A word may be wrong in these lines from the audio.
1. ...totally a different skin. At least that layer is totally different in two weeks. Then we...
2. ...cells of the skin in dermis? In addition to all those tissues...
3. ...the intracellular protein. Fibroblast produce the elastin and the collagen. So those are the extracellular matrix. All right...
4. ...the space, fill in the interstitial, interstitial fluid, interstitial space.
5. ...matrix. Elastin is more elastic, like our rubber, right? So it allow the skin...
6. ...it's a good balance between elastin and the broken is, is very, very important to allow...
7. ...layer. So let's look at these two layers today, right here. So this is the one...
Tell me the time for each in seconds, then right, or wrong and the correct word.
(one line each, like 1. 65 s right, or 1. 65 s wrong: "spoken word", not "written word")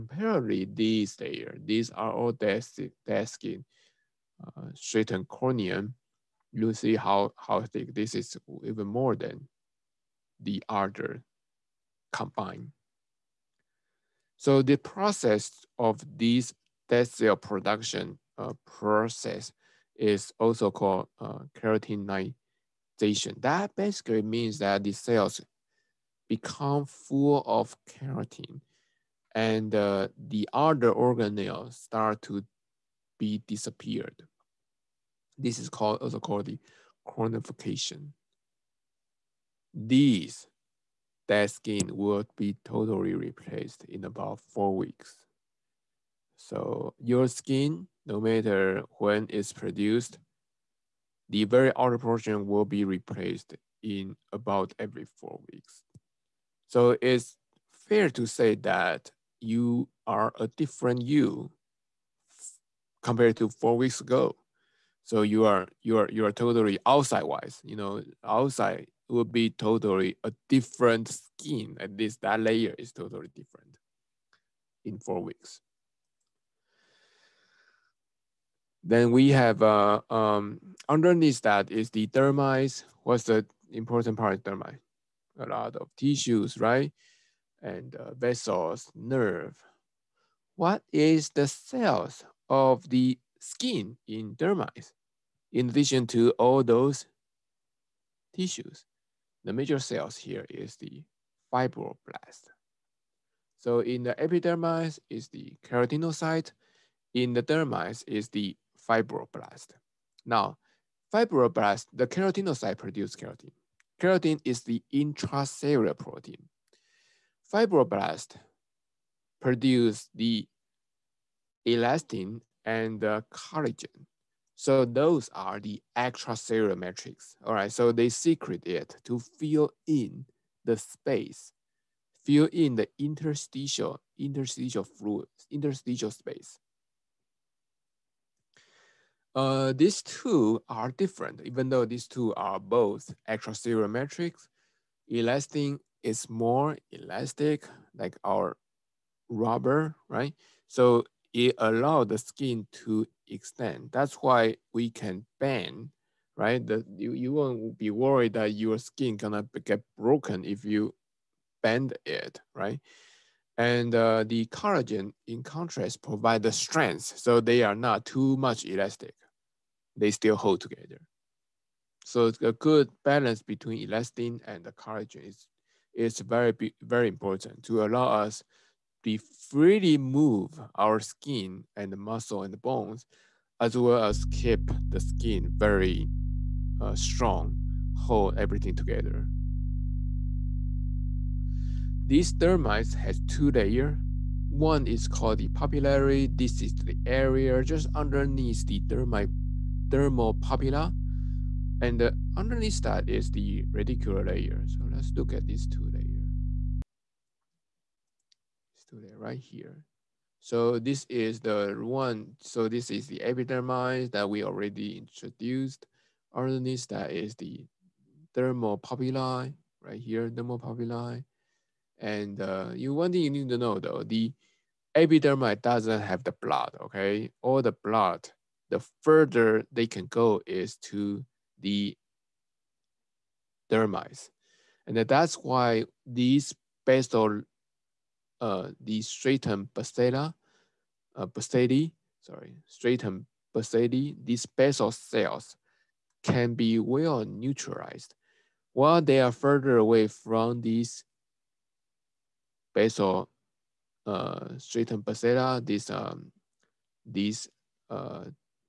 1. 69 s wrong: "four", not "two"
2. 91 s right
3. 114 s right
4. 130 s right
5. 143 s right
6. 172 s wrong: "collagen", not "broken"
7. 204 s right.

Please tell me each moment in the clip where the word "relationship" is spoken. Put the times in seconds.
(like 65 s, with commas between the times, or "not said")
not said.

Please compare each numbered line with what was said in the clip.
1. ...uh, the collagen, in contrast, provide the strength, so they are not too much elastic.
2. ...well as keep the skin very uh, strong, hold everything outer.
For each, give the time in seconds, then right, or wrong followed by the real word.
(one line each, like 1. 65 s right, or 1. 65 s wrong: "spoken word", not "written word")
1. 163 s right
2. 183 s wrong: "together", not "outer".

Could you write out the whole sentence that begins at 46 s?
So your skin, no matter when it's produced, the very outer portion will be replaced in about every four weeks.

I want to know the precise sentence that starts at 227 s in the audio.
All the blood, the further they can go is to the dermis.